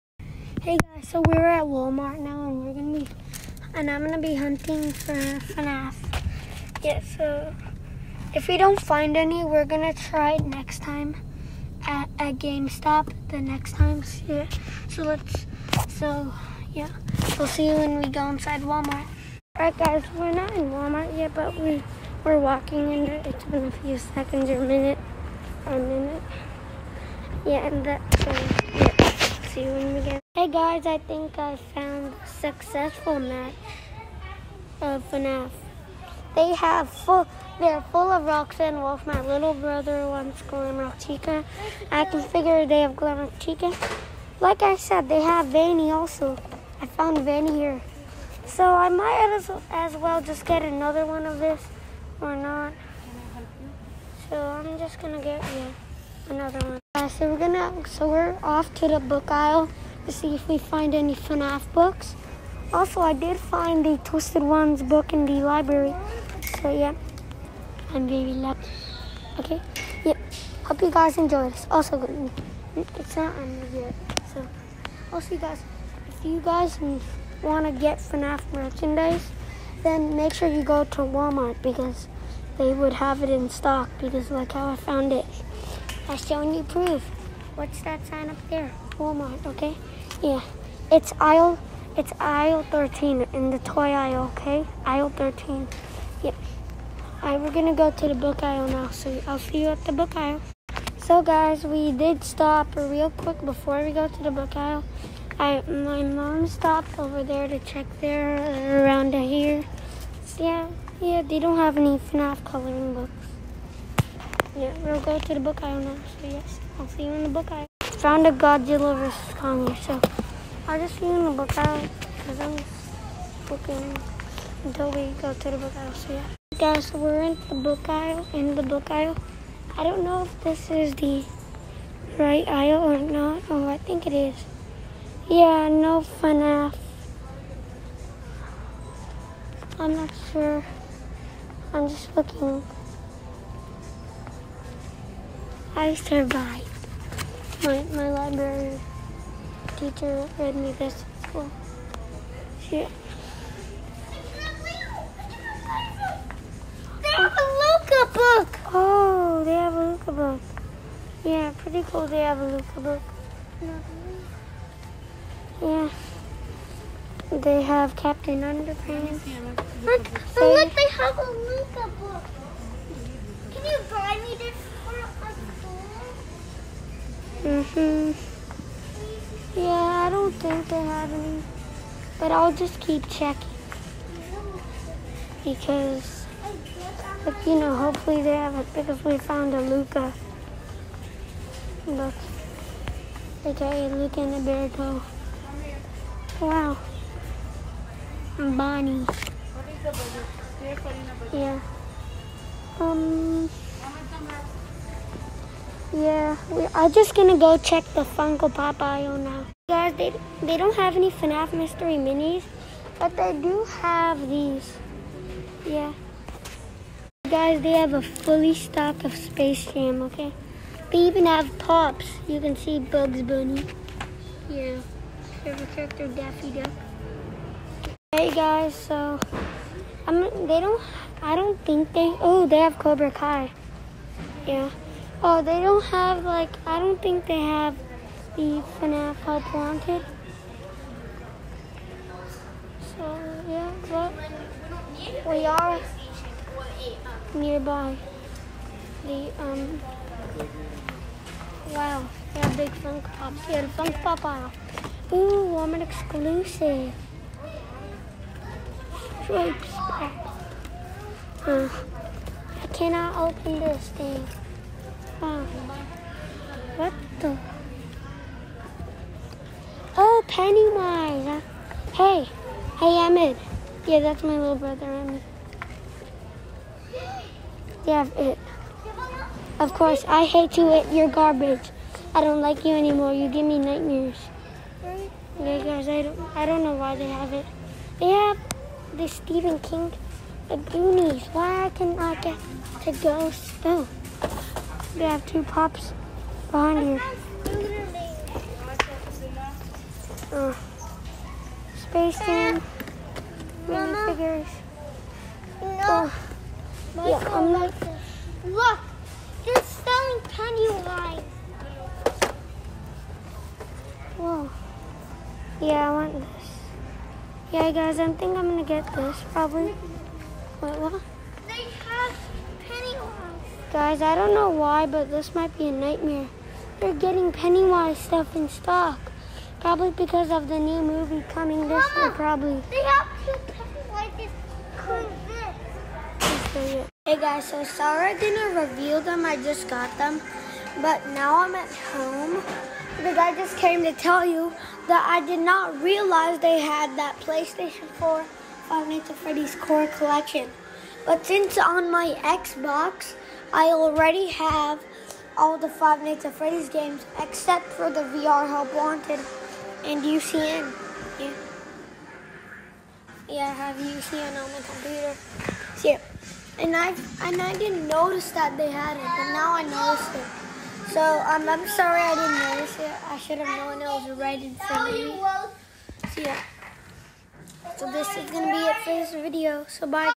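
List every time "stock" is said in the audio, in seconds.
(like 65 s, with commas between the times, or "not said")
83 s, 218 s, 328 s.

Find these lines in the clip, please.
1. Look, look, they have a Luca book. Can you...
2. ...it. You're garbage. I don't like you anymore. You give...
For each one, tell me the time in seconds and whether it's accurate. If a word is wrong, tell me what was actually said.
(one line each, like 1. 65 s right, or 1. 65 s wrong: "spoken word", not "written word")
1. 169 s right
2. 280 s right.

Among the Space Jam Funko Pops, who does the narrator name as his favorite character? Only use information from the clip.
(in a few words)
Daffy Duck.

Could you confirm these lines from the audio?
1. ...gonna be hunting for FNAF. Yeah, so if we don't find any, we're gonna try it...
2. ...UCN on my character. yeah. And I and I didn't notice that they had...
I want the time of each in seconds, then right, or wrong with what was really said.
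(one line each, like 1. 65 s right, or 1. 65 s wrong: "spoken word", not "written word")
1. 4 s right
2. 363 s wrong: "computer", not "character".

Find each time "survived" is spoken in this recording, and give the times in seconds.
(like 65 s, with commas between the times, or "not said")
145 s.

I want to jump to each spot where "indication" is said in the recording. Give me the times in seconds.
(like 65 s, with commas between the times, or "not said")
not said.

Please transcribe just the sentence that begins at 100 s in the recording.
So guys, we did stop real quick before we go to the book aisle.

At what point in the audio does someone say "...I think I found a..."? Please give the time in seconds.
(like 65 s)
30 s.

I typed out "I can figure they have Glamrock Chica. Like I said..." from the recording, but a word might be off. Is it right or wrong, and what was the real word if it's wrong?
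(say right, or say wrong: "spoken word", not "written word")
right.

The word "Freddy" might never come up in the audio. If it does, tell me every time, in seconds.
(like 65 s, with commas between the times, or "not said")
349 s, 356 s.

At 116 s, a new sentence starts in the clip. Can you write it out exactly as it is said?
So yes, I'll see you in the book aisle found a Godzilla vs.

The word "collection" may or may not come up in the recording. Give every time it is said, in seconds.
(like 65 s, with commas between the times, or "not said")
349 s.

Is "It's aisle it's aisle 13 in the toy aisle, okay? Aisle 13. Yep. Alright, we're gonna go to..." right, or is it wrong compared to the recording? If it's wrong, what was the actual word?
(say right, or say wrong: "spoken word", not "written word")
right.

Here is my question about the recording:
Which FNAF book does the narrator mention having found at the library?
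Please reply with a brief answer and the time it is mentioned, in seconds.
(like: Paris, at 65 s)
The Twisted Ones, at 64 s.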